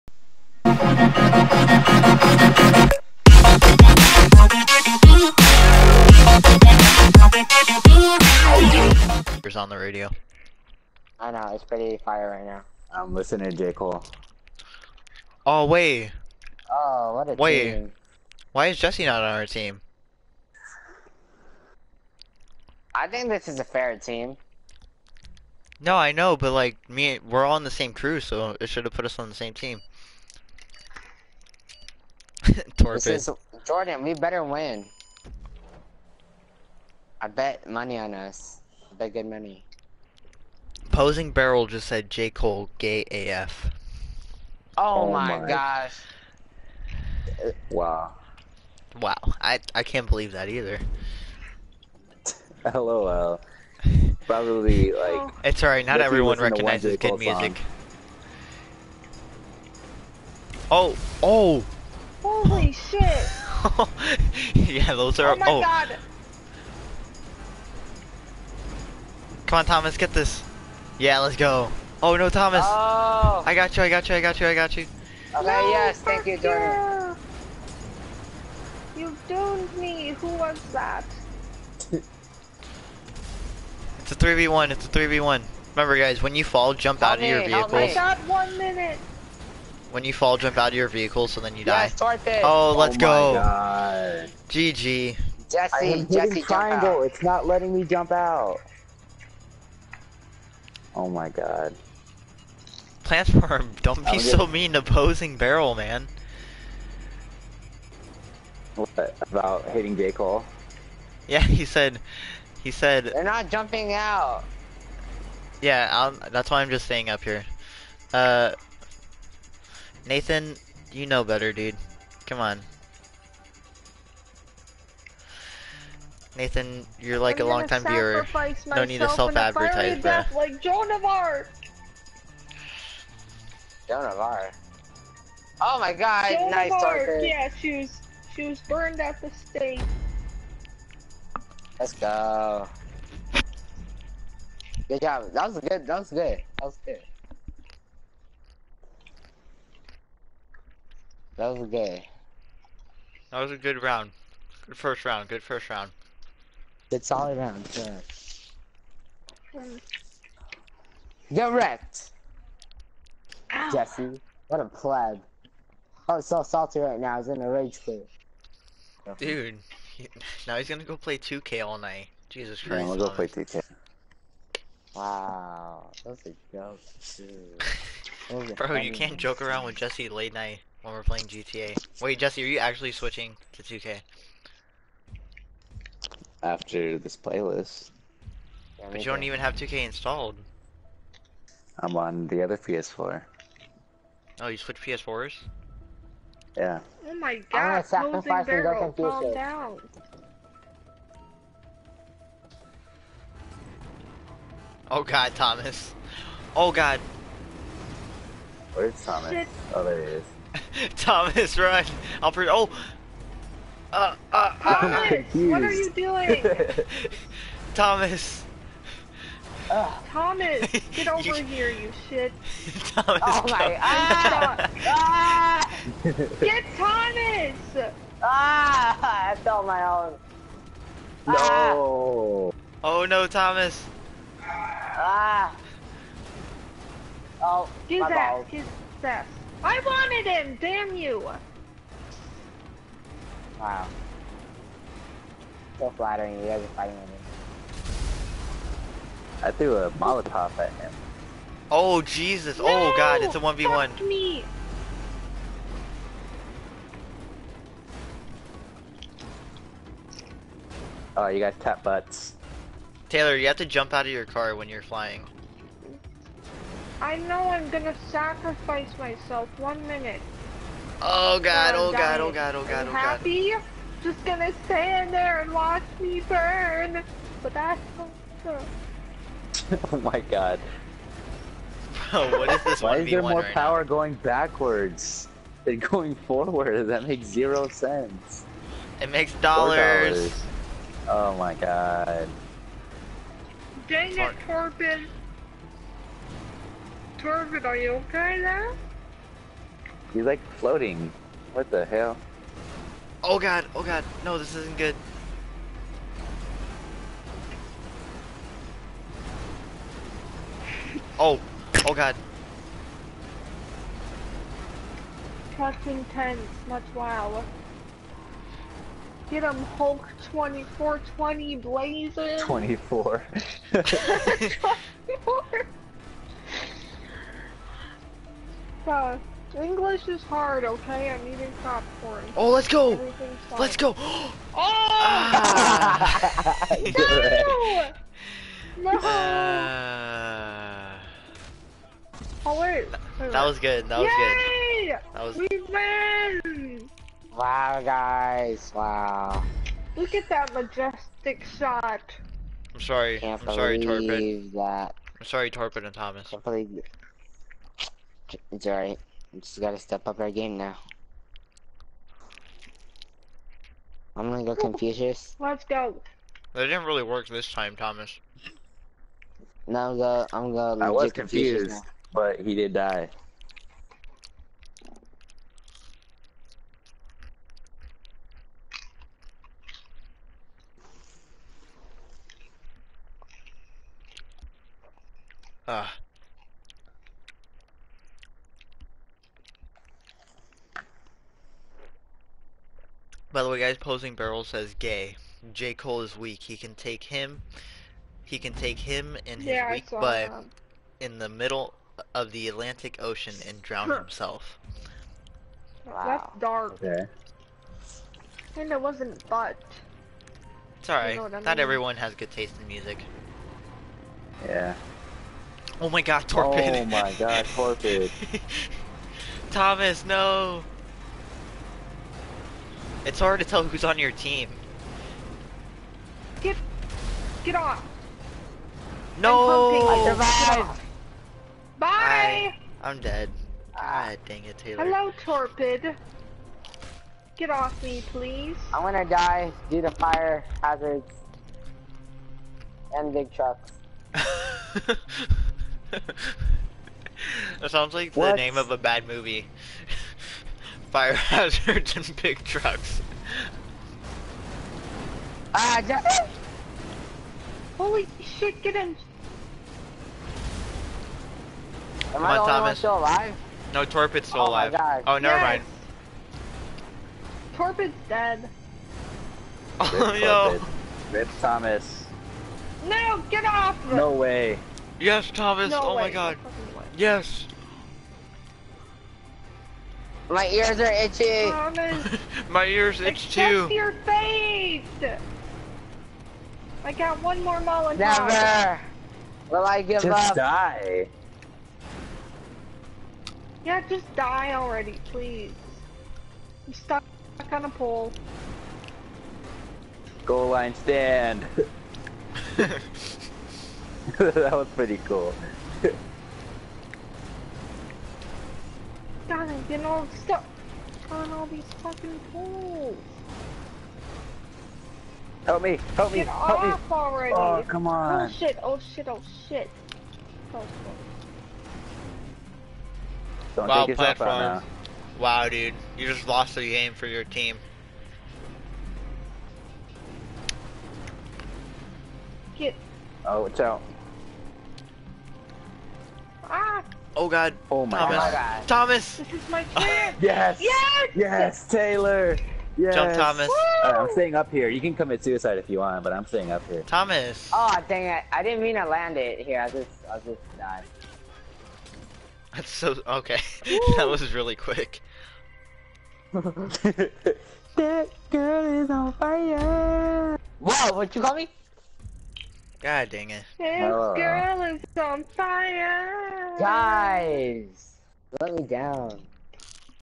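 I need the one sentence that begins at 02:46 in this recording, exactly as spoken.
Oh, I was so salty right now.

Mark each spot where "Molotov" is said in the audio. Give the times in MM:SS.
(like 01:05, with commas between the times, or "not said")
04:09, 08:07.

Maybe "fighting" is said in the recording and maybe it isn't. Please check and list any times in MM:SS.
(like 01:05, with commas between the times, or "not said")
04:06.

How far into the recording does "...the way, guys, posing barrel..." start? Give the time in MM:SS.
06:33.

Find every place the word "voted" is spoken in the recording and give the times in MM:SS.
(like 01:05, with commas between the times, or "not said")
not said.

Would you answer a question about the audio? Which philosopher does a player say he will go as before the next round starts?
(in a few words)
Confucius.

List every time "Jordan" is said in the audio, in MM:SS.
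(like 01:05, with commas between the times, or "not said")
00:33, 01:16.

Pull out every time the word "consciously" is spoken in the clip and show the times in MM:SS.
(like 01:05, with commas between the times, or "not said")
not said.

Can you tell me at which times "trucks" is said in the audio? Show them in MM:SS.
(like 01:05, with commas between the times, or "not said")
07:23, 07:32.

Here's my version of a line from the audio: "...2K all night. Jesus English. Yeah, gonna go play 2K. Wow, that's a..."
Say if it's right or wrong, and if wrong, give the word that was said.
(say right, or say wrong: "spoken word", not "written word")
wrong: "Christ", not "English".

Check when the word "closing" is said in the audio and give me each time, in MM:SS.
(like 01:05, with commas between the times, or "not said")
03:17.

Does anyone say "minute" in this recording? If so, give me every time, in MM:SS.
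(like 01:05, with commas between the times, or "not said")
01:28, 04:29.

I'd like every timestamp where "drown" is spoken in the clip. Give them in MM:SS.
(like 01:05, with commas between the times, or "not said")
06:43.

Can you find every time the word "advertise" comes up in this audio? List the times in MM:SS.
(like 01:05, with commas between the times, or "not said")
02:09.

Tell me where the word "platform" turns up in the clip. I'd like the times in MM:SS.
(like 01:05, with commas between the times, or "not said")
01:43, 08:43.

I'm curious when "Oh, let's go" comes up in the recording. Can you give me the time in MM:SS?
05:32.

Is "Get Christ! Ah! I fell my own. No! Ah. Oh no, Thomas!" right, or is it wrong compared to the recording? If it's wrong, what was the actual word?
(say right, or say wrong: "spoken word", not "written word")
wrong: "Thomas", not "Christ".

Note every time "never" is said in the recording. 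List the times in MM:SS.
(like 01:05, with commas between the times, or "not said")
07:45, 08:07.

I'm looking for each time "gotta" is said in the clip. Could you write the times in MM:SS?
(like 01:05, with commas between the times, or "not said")
05:59.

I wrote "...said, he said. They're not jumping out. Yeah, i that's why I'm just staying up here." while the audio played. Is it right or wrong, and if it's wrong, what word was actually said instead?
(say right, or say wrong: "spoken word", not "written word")
right.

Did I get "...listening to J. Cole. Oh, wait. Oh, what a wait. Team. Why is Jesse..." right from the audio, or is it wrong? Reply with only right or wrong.
right.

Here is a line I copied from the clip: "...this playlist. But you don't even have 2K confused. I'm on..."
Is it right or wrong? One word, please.
wrong.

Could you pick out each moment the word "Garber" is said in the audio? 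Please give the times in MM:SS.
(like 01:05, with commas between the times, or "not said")
not said.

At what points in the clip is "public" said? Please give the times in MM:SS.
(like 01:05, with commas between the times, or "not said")
not said.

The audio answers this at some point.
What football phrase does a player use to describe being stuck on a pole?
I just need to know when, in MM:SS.
08:20.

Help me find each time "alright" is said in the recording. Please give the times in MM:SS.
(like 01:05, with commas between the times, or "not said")
00:55, 05:58, 06:50.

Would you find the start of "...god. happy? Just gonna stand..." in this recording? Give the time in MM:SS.
04:32.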